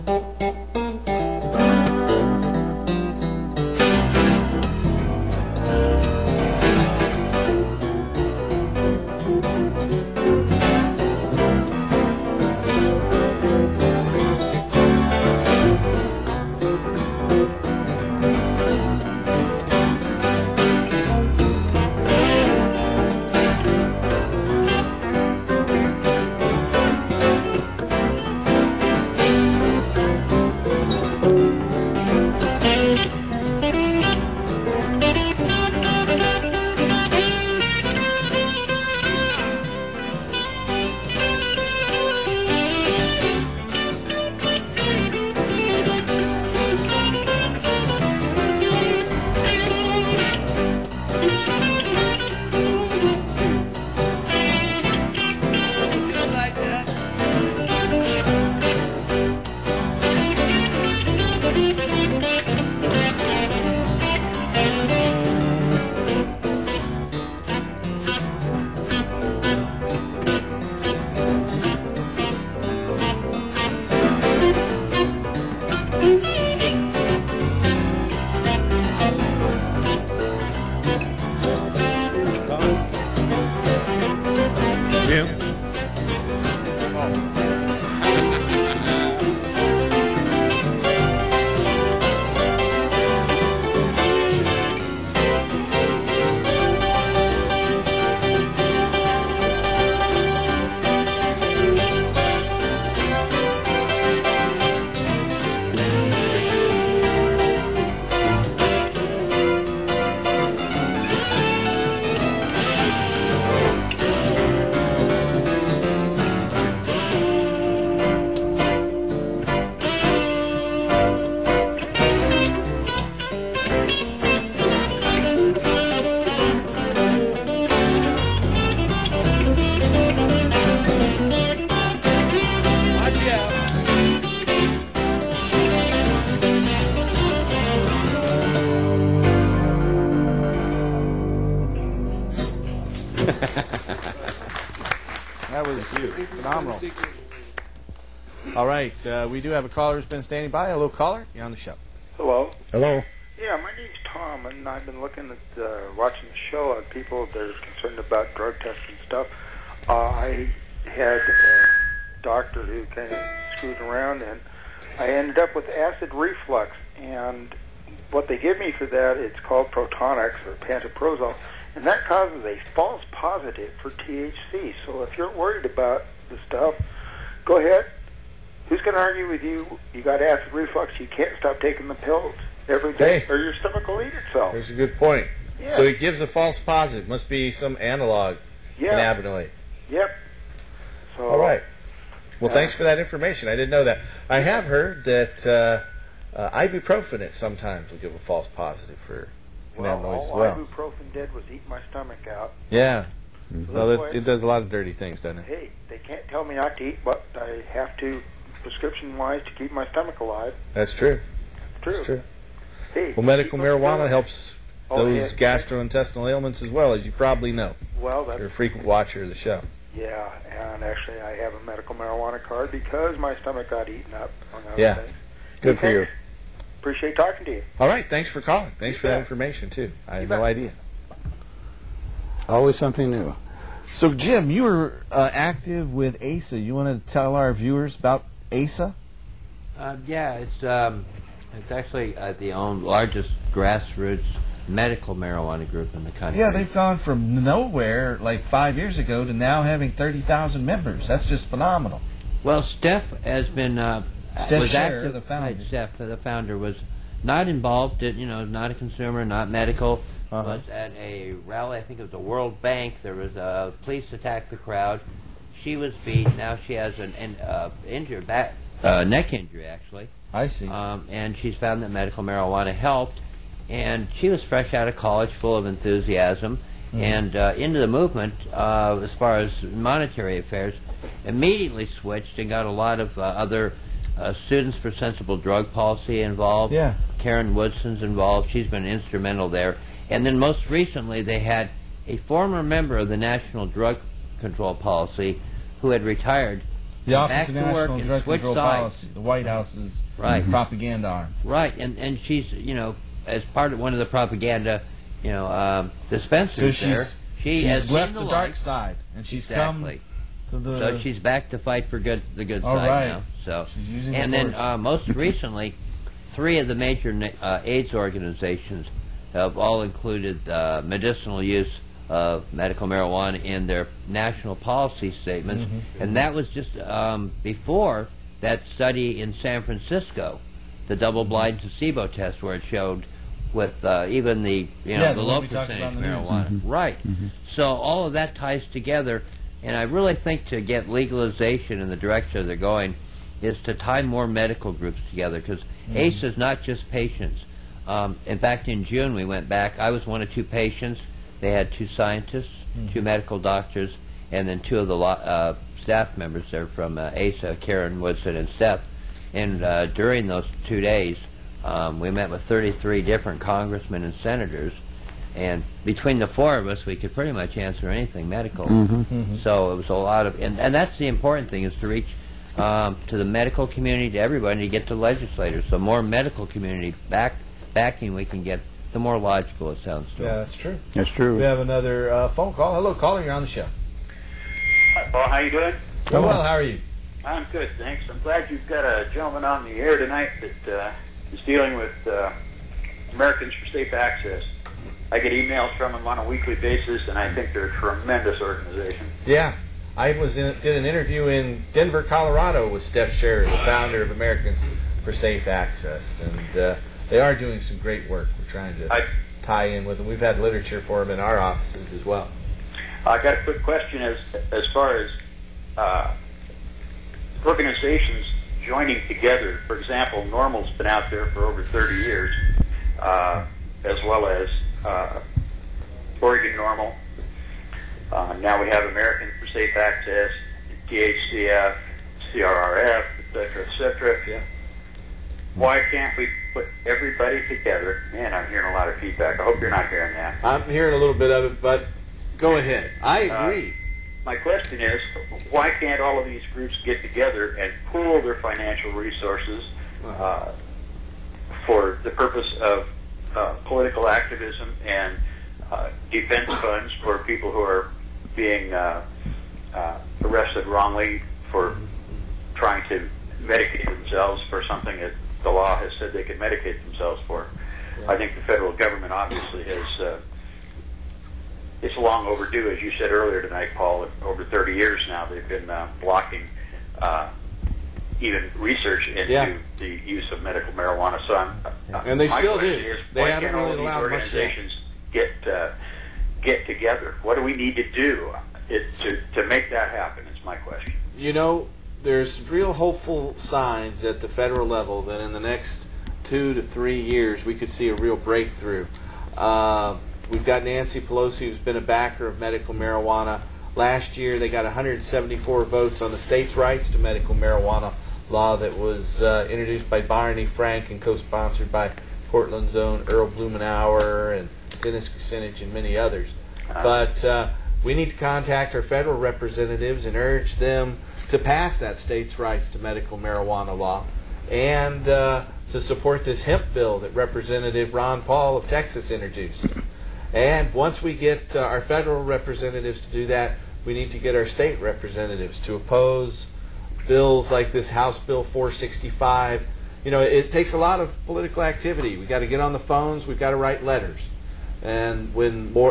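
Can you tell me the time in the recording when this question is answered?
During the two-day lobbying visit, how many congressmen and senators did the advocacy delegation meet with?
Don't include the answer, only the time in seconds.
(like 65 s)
362 s.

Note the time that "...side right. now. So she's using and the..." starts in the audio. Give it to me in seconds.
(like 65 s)
312 s.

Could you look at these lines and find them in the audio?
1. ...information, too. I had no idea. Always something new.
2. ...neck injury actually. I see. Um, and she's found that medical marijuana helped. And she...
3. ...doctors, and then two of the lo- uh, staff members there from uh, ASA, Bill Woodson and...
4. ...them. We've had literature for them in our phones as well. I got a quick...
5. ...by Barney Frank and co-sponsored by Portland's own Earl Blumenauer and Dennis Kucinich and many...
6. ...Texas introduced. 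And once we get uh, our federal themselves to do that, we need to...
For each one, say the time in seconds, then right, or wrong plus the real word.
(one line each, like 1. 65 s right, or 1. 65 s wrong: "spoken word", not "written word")
1. 229 s right
2. 269 s right
3. 353 s wrong: "Caren", not "Bill"
4. 409 s wrong: "offices", not "phones"
5. 509 s right
6. 528 s wrong: "representatives", not "themselves".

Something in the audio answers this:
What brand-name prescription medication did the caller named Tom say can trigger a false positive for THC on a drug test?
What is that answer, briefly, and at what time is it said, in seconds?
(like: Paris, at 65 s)
Protonix, at 169 s.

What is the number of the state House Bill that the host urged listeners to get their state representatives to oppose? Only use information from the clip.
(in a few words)
465.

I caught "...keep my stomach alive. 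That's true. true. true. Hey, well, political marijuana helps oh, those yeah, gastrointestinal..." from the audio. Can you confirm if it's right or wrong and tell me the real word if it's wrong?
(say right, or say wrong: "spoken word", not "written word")
wrong: "medical", not "political".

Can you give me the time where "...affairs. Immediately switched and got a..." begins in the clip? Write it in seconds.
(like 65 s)
280 s.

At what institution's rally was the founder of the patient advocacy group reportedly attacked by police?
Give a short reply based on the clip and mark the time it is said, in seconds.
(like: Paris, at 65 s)
World Bank, at 262 s.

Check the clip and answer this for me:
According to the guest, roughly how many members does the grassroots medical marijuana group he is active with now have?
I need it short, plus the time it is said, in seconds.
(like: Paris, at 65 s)
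30,000, at 249 s.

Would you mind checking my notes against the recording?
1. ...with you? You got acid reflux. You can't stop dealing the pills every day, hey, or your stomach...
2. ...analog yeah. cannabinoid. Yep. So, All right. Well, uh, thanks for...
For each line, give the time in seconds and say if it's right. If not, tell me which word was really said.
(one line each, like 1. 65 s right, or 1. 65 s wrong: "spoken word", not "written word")
1. 179 s wrong: "taking", not "dealing"
2. 187 s right.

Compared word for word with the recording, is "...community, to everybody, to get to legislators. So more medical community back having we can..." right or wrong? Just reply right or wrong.
wrong.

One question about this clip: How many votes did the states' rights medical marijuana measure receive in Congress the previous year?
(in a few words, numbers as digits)
174.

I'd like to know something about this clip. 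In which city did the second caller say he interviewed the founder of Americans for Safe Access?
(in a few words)
Denver.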